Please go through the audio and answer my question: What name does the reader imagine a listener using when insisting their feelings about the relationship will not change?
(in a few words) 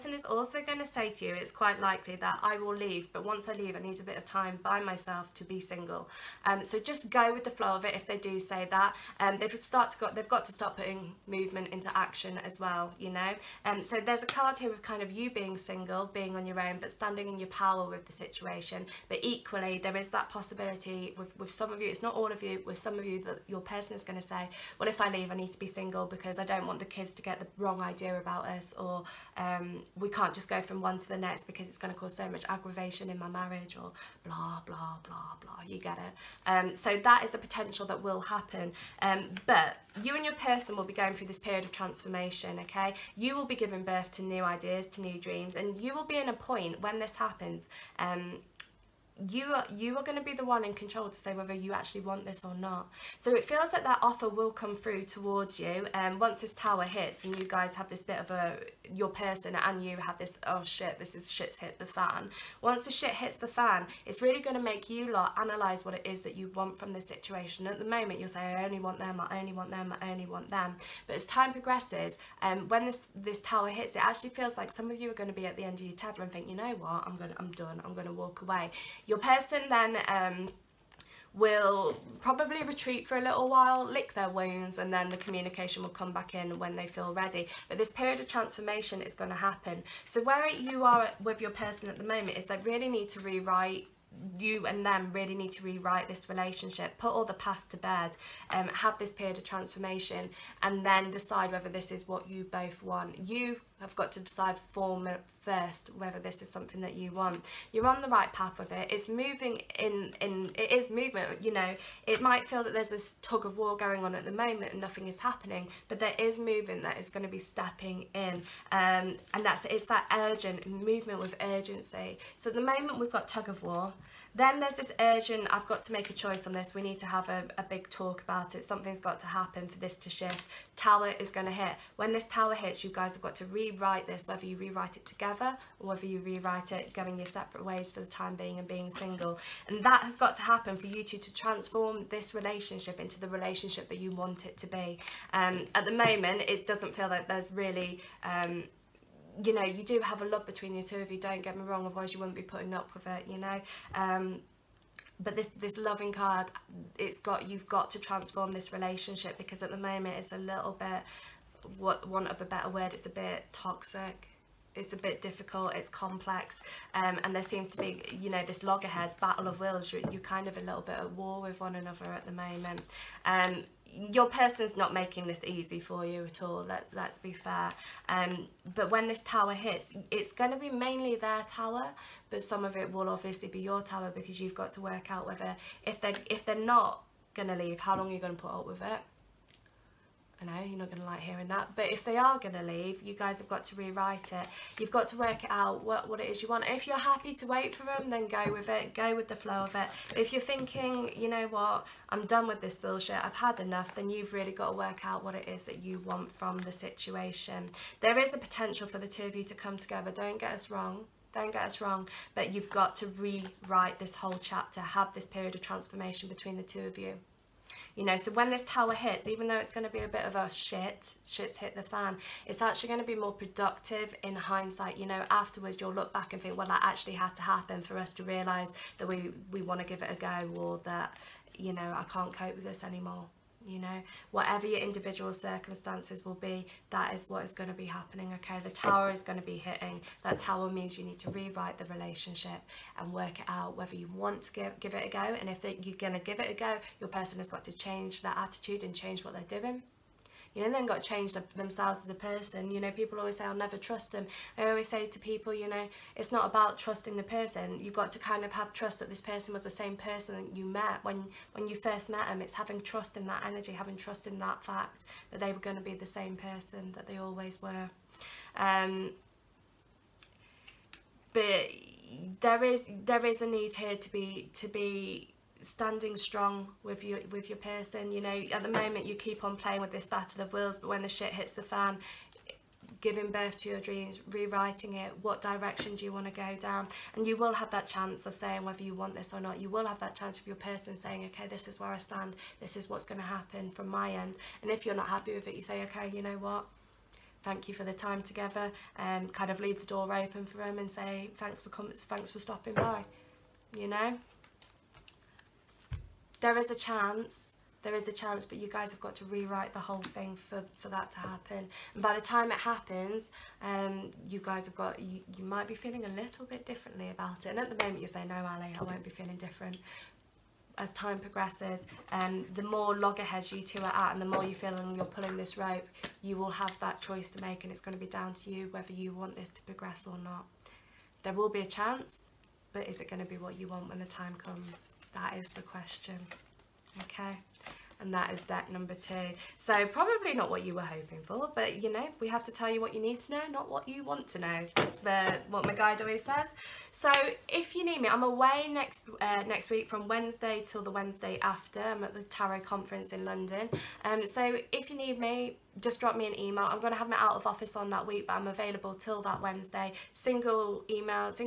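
Ally.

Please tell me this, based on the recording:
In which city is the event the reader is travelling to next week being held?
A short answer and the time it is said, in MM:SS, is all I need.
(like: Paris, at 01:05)
London, at 05:53.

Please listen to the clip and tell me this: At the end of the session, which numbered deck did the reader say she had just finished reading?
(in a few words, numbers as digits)
Deck number two.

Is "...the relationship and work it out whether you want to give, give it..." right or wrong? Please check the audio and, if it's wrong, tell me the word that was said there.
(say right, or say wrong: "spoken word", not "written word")
right.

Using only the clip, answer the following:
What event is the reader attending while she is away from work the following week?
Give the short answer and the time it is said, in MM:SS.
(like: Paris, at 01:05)
The Tarot Conference, at 05:52.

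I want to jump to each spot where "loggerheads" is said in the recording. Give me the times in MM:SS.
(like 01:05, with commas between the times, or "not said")
02:48, 05:22.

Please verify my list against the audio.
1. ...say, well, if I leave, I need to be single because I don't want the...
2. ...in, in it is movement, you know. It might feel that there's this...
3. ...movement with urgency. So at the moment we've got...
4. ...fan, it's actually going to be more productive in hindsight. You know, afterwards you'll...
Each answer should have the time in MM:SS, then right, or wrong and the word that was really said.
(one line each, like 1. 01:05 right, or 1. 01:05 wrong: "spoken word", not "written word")
1. 00:24 right
2. 01:49 right
3. 02:00 right
4. 03:41 right.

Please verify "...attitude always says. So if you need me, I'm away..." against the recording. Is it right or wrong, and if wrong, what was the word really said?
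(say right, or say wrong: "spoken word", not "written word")
wrong: "guide", not "attitude".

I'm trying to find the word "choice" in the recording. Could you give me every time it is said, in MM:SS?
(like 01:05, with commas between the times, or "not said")
02:06, 05:27.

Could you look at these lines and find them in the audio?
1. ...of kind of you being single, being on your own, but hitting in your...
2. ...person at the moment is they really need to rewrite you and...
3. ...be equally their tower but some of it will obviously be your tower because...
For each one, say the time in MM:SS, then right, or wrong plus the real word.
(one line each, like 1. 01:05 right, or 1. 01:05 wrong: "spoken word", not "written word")
1. 00:14 wrong: "standing", not "hitting"
2. 01:31 right
3. 03:00 wrong: "mainly", not "equally".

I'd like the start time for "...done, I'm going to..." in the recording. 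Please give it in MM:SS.
01:17.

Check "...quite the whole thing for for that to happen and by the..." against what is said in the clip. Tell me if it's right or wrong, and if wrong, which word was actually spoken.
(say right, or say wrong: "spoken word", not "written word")
wrong: "rewrite", not "quite".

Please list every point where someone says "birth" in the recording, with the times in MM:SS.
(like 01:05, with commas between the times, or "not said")
00:43, 04:43.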